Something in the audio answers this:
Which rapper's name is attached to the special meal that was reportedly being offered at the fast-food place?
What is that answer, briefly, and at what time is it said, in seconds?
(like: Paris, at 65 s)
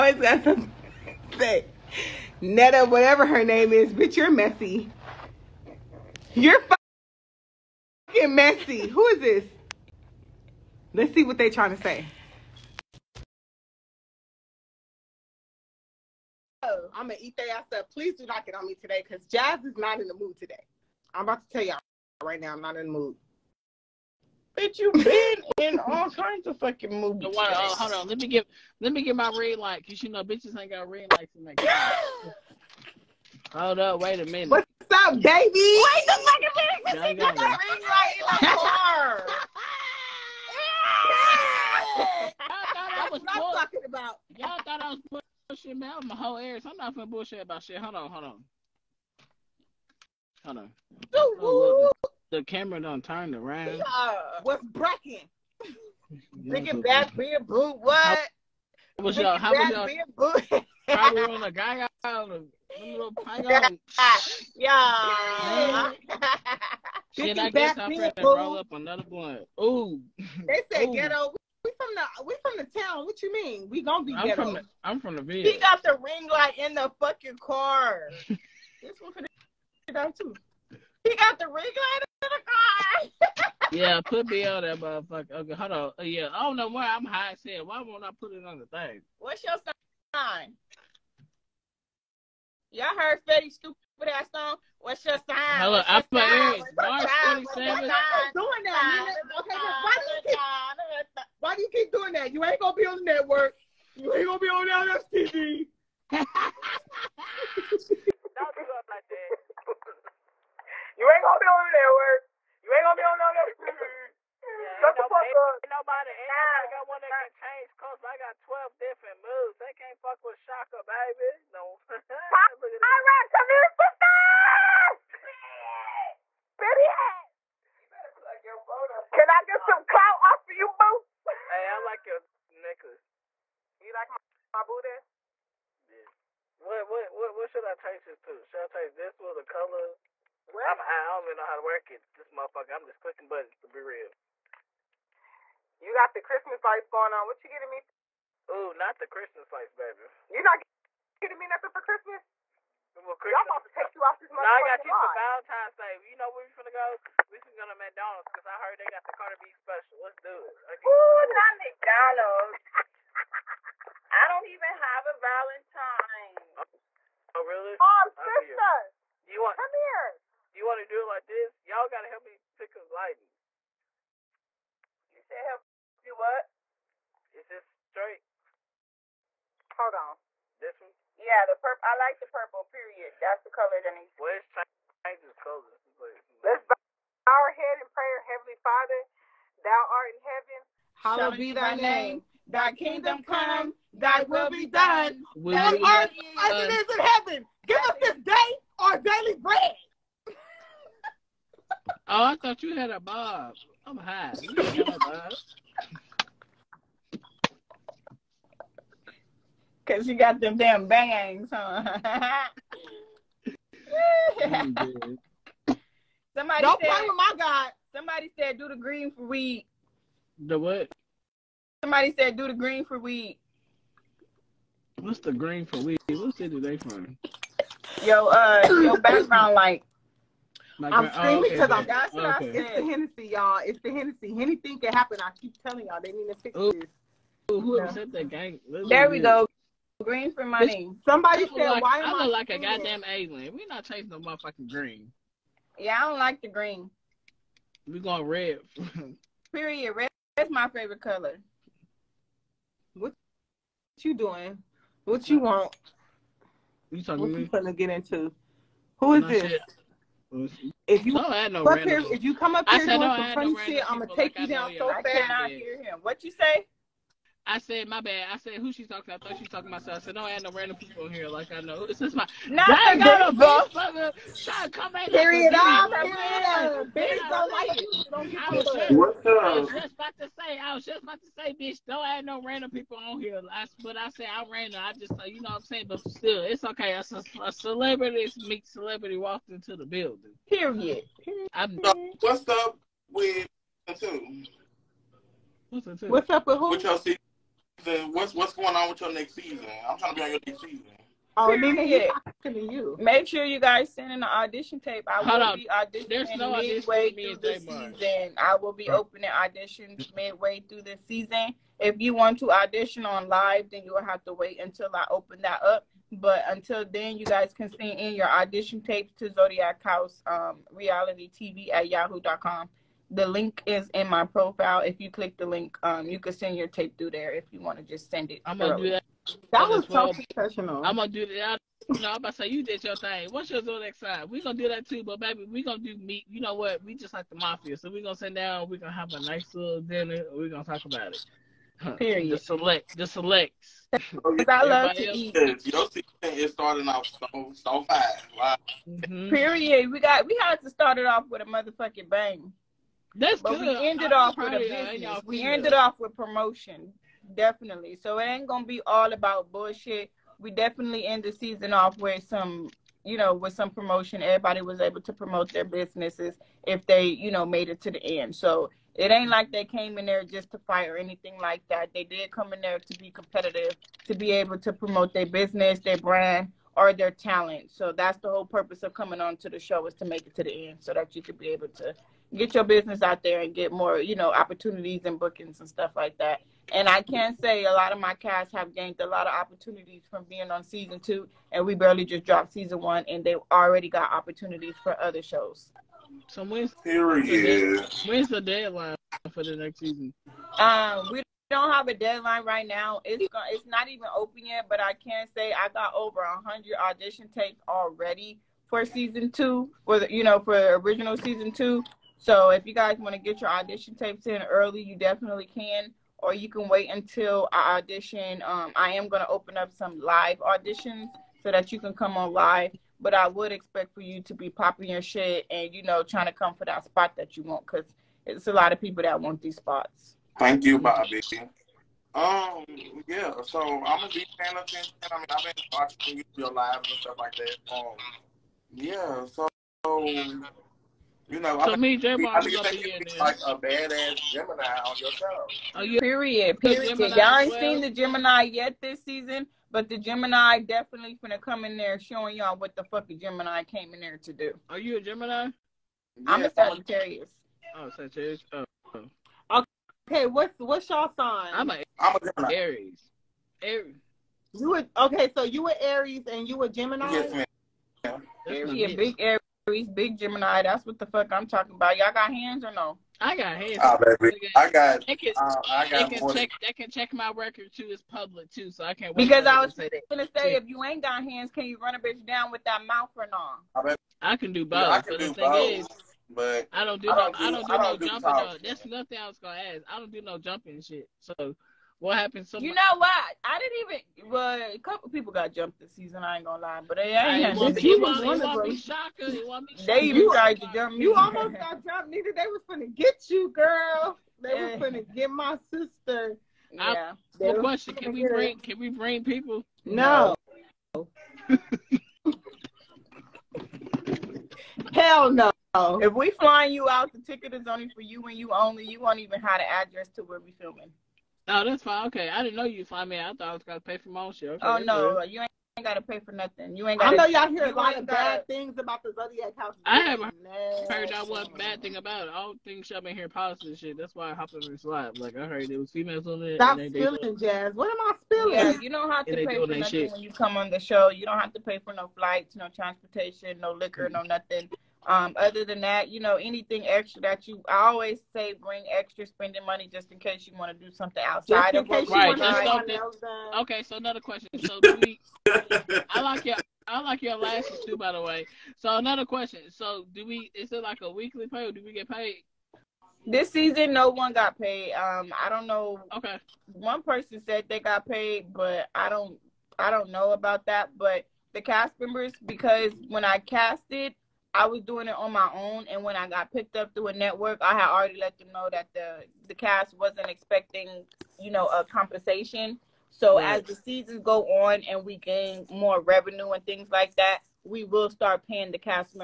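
Cardi B, at 159 s.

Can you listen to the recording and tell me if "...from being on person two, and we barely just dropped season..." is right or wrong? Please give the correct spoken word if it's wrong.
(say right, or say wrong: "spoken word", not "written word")
wrong: "season", not "person".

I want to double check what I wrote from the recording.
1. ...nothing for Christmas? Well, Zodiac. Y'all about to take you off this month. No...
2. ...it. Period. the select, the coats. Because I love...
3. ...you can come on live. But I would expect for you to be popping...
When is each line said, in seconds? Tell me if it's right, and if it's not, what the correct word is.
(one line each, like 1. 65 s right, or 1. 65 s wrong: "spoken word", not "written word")
1. 151 s wrong: "Christmas", not "Zodiac"
2. 341 s wrong: "selects", not "coats"
3. 421 s right.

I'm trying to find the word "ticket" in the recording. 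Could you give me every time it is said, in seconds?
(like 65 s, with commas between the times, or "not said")
517 s.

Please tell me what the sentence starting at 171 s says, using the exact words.
Y'all gotta help me pick a lighting.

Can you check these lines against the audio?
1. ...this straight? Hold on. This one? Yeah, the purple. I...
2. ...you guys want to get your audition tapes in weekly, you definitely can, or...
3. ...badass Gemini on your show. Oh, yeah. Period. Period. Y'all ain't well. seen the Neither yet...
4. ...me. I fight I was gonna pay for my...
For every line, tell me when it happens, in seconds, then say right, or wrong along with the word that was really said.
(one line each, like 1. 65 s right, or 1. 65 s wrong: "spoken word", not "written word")
1. 177 s right
2. 412 s wrong: "early", not "weekly"
3. 443 s wrong: "Gemini", not "Neither"
4. 523 s wrong: "thought", not "fight".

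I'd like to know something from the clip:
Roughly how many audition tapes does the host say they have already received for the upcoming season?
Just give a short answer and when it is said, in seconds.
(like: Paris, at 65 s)
over 100, at 405 s.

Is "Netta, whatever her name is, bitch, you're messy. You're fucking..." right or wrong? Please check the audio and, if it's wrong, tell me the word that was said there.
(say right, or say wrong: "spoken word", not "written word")
right.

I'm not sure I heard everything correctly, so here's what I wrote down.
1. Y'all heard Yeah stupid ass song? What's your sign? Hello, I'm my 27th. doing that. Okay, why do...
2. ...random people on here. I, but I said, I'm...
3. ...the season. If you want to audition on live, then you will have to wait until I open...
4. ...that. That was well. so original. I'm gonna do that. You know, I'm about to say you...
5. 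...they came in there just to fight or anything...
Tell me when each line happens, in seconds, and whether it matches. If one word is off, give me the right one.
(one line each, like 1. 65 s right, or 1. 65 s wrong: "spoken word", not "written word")
1. 92 s wrong: "Fetty", not "Yeah"
2. 282 s right
3. 310 s right
4. 328 s wrong: "professional", not "original"
5. 369 s right.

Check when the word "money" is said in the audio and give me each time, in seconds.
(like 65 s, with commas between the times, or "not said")
240 s, 549 s.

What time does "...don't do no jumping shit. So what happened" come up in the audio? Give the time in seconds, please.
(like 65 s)
489 s.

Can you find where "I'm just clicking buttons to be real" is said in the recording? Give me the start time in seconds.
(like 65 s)
142 s.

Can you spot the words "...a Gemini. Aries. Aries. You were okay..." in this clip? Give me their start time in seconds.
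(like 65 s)
462 s.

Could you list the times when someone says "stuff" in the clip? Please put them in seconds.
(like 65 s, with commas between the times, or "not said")
385 s, 437 s.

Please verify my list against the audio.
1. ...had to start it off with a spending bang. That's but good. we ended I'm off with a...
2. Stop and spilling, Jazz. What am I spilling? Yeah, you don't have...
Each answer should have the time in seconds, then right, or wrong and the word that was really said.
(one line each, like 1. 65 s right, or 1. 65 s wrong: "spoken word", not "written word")
1. 350 s wrong: "motherfucking", not "spending"
2. 536 s right.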